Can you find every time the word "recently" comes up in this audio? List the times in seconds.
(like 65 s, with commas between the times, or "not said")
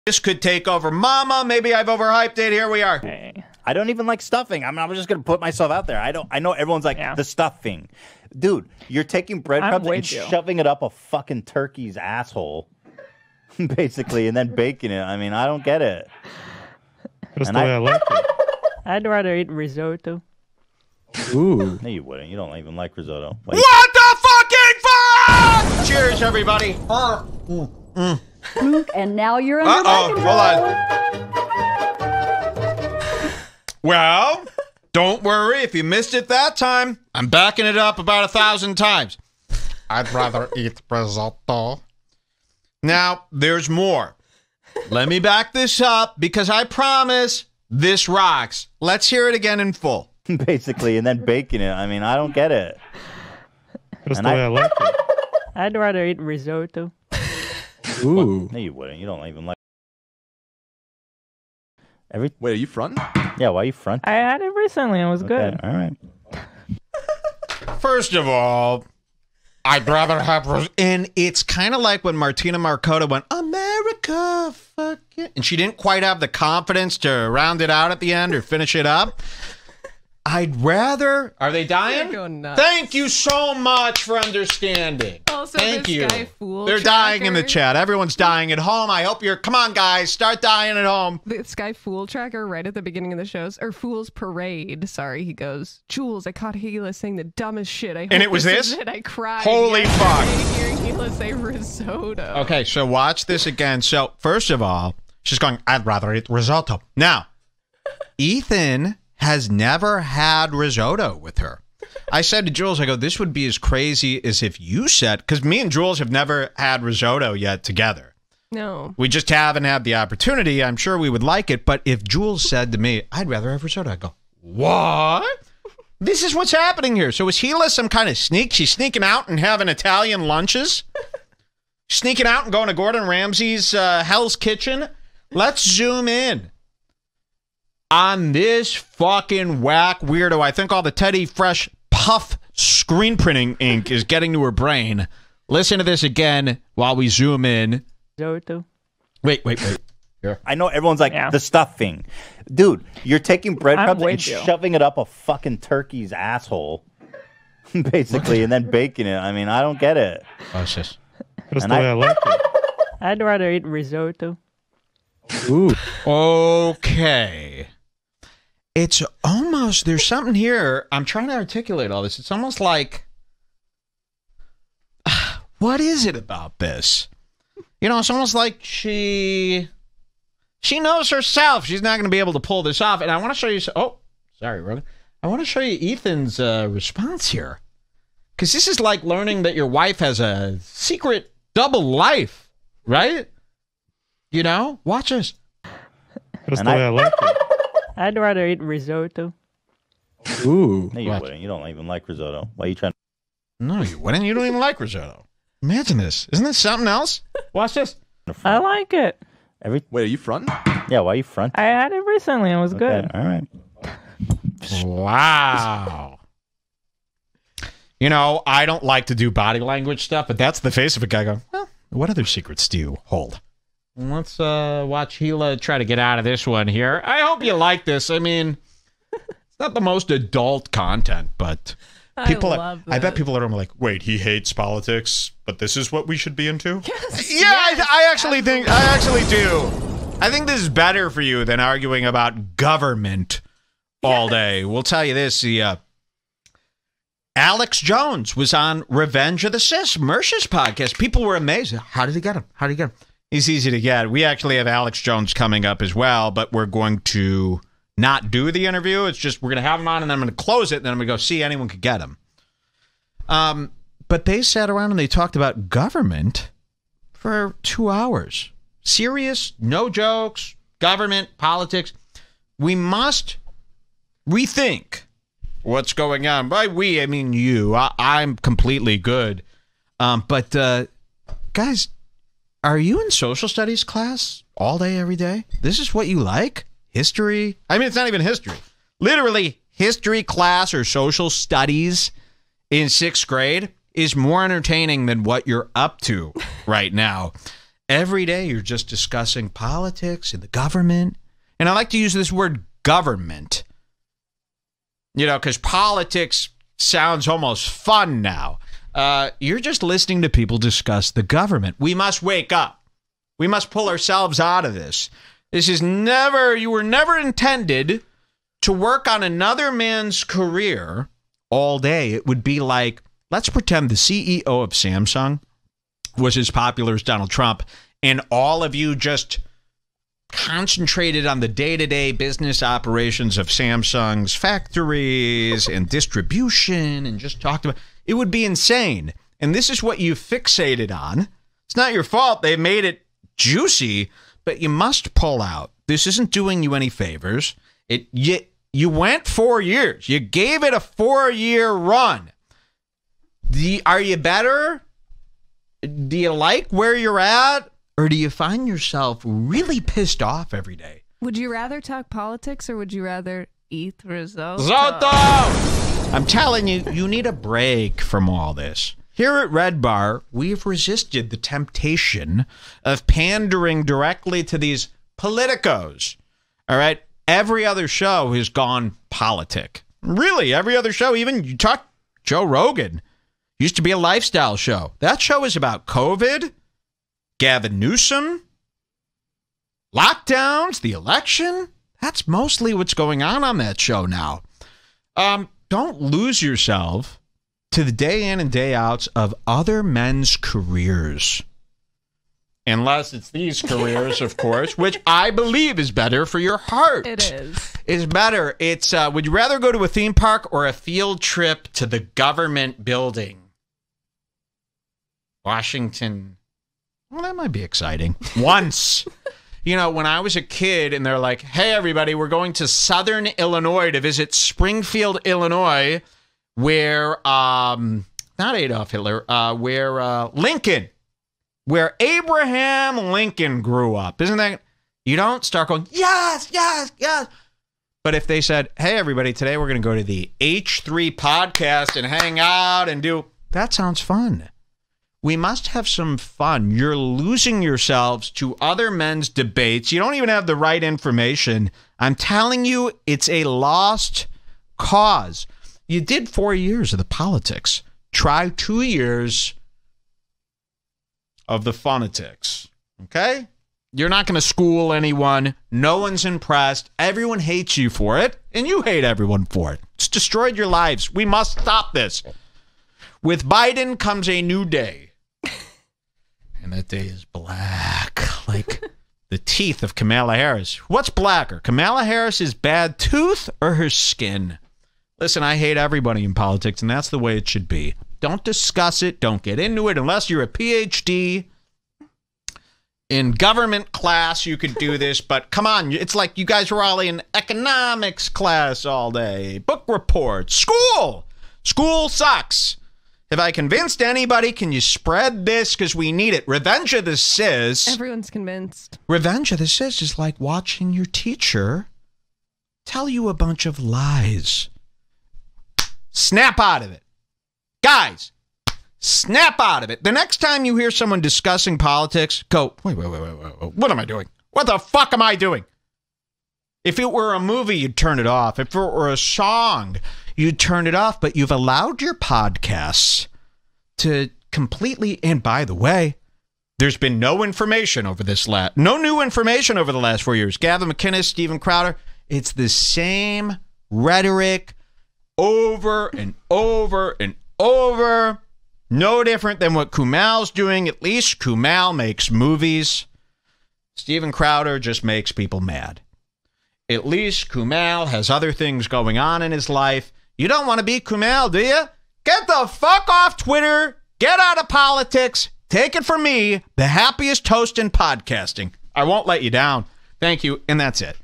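64 s, 212 s.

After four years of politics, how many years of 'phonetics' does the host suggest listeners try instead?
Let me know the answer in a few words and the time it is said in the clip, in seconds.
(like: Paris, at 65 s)
2, at 458 s.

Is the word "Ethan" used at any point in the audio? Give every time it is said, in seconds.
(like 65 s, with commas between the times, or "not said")
108 s, 185 s.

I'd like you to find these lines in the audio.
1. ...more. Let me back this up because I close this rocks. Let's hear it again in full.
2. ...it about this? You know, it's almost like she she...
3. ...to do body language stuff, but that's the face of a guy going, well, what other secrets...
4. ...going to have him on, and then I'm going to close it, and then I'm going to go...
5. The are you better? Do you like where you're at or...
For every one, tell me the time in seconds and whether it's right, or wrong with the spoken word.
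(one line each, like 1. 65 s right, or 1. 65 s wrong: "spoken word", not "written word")
1. 43 s wrong: "promise", not "close"
2. 176 s right
3. 219 s right
4. 259 s right
5. 353 s right.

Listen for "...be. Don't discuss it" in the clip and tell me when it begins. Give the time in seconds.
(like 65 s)
487 s.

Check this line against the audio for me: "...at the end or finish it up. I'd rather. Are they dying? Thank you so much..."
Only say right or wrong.
right.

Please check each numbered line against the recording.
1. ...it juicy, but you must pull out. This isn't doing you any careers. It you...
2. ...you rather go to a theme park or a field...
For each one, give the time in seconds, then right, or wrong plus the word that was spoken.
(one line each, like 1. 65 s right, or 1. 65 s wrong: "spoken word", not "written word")
1. 342 s wrong: "favors", not "careers"
2. 409 s right.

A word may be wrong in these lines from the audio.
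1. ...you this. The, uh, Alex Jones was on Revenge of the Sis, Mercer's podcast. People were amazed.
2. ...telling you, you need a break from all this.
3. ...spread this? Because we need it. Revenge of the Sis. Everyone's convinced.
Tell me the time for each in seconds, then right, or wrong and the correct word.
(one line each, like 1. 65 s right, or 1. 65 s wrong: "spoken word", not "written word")
1. 245 s right
2. 366 s right
3. 504 s right.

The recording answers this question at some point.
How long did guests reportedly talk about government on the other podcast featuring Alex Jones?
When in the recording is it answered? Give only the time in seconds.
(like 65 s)
267 s.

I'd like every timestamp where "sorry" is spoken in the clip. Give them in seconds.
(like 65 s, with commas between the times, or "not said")
94 s, 184 s.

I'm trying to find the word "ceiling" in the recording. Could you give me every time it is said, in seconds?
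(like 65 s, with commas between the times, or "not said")
not said.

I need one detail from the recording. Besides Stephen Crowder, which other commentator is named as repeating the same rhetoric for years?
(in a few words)
Gavin McInnes.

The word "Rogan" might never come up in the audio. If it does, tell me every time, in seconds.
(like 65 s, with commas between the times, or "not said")
184 s, 382 s.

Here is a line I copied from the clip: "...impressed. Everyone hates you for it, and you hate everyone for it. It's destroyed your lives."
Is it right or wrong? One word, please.
right.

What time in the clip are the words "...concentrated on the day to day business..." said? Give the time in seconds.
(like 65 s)
330 s.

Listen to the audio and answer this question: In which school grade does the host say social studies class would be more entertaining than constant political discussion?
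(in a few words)
Sixth grade.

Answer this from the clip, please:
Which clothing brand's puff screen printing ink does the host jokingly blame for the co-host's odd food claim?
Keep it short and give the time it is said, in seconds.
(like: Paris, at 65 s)
Teddy Fresh, at 140 s.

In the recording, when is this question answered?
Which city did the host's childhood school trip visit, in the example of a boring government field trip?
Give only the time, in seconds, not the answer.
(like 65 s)
424 s.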